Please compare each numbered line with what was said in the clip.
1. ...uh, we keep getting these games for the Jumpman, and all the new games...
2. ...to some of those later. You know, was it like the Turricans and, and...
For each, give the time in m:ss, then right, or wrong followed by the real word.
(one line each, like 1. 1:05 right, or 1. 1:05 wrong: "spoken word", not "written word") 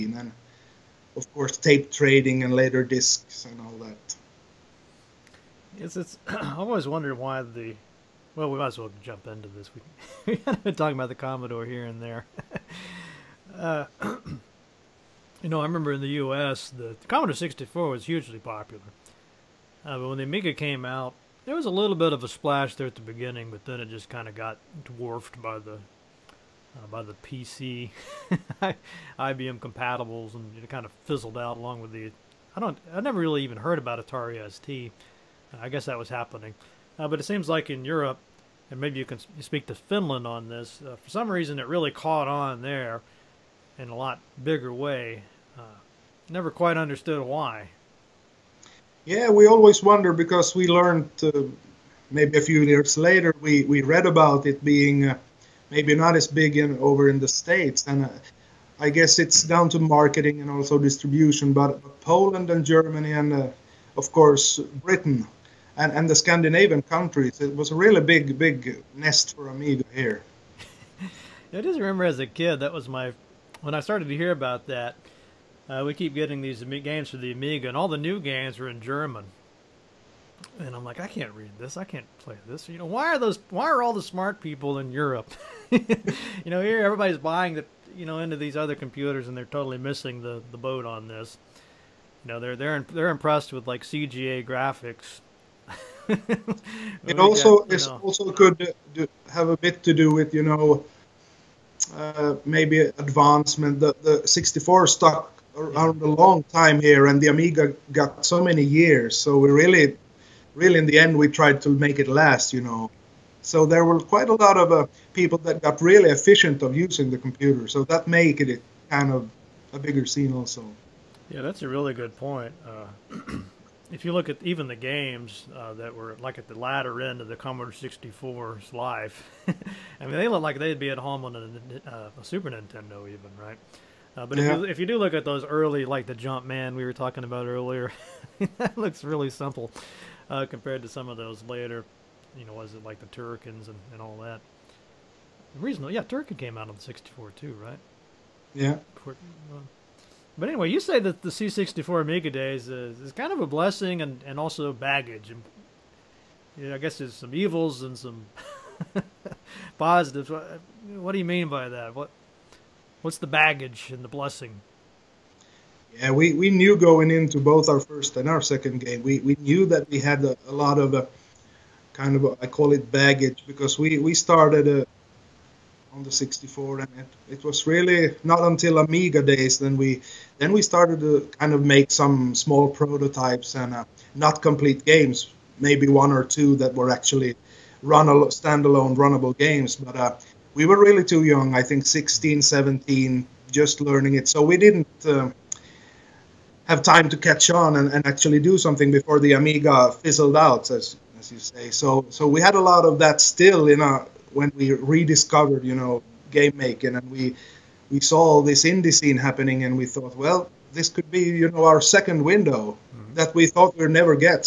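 1. 1:15 wrong: "Amiga", not "Jumpman"
2. 2:20 right.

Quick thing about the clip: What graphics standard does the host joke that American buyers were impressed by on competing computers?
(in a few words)
CGA.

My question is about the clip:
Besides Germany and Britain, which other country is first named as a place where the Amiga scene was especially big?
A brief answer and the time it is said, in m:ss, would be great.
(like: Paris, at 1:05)
Poland, at 1:02.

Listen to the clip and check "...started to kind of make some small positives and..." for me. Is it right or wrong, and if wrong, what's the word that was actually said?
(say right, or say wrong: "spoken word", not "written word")
wrong: "prototypes", not "positives".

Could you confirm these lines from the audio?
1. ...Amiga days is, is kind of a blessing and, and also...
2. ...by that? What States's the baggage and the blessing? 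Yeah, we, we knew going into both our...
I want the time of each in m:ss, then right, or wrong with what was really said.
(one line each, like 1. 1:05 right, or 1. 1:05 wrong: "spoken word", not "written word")
1. 2:32 right
2. 2:41 wrong: "What", not "States".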